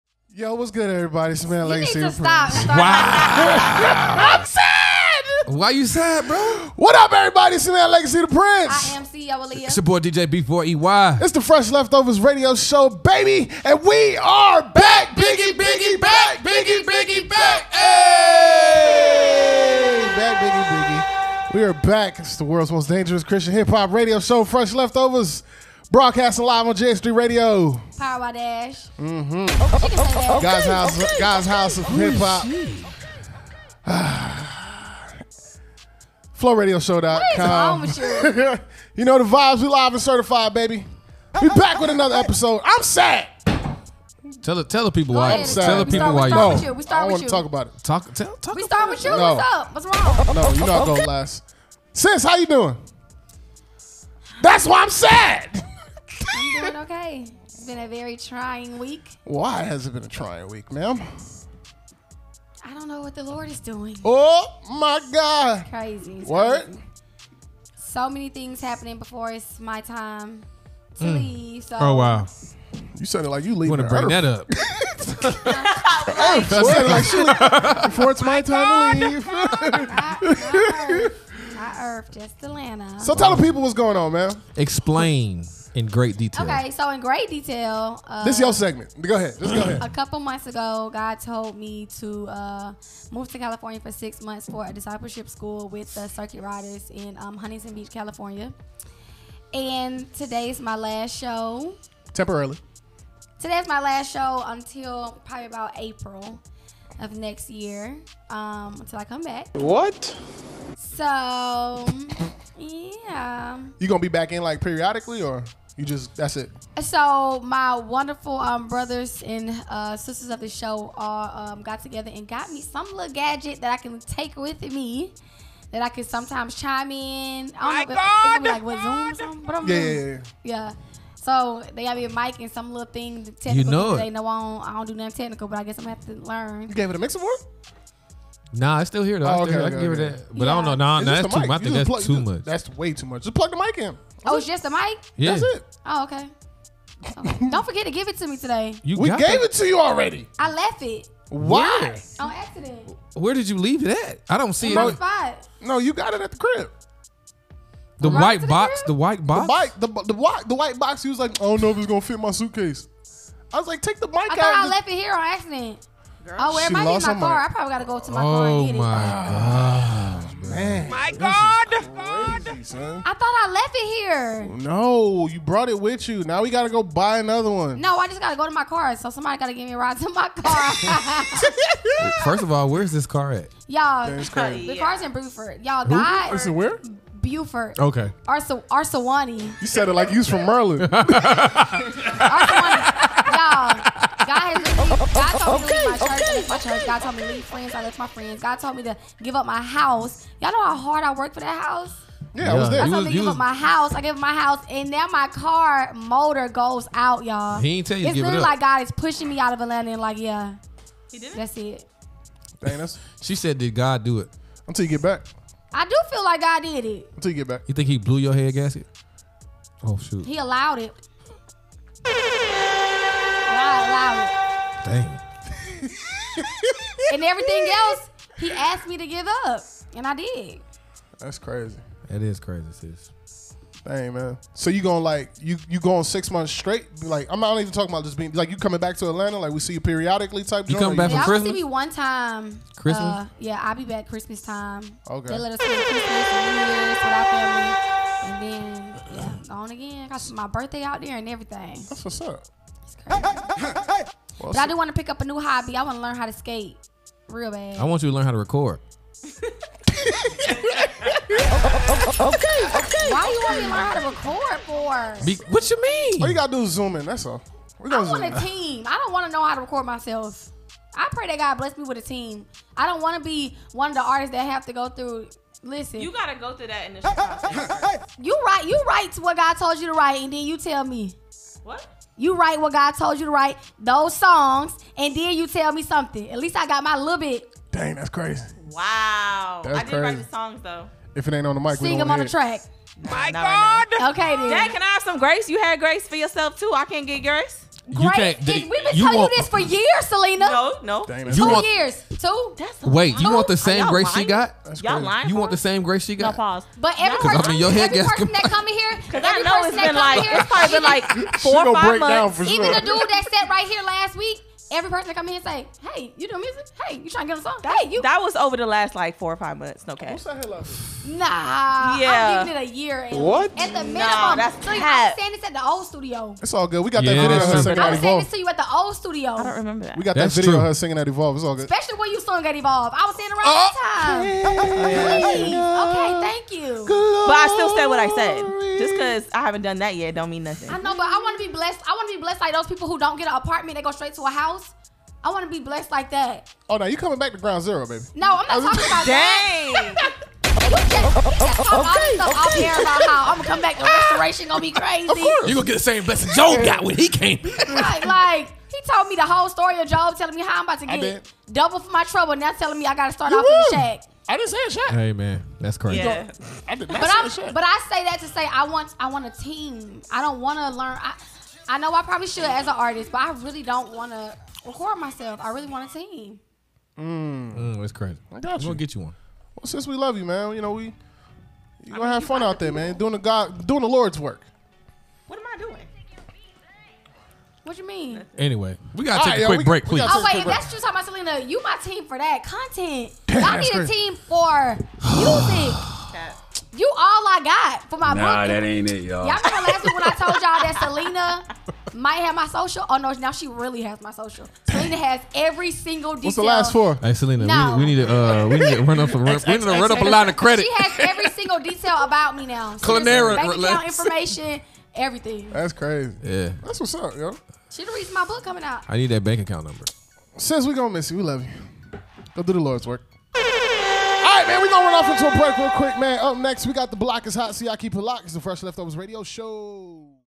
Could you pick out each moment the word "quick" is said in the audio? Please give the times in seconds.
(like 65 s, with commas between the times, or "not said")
389 s, 425 s.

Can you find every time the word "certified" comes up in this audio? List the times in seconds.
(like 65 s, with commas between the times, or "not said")
40 s.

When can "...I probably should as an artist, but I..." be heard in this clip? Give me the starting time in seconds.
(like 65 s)
371 s.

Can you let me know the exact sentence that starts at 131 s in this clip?
So they got me a mic and some little thing technical.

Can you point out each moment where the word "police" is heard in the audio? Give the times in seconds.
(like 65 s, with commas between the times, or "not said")
not said.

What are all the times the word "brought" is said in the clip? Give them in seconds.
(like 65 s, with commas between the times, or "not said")
175 s.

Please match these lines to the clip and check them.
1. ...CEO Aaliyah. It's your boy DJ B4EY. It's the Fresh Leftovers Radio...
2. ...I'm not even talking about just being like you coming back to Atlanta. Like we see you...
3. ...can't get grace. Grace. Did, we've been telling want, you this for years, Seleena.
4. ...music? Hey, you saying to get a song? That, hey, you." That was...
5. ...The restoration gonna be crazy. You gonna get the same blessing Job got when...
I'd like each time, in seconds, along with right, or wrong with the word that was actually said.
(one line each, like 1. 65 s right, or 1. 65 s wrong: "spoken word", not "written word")
1. 9 s right
2. 237 s right
3. 296 s right
4. 316 s wrong: "trying", not "saying"
5. 353 s right.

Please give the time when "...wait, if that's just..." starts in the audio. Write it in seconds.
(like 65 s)
390 s.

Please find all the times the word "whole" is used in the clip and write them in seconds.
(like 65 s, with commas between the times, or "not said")
359 s.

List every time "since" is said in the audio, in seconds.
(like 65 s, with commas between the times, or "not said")
379 s, 420 s.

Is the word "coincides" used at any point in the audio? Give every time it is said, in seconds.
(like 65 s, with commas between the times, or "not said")
not said.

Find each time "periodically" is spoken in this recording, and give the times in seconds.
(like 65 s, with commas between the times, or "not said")
114 s, 239 s.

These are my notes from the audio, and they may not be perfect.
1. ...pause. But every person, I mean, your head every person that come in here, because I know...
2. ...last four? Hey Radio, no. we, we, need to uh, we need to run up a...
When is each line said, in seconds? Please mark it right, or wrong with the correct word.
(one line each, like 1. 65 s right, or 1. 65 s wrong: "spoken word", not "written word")
1. 306 s right
2. 406 s wrong: "Seleena", not "Radio".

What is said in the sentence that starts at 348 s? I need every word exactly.
No, I'm not talking about that.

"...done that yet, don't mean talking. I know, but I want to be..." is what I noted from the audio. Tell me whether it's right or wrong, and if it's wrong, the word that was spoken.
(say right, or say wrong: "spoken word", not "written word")
wrong: "nothing", not "talking".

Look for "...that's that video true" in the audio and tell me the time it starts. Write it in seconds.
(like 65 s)
330 s.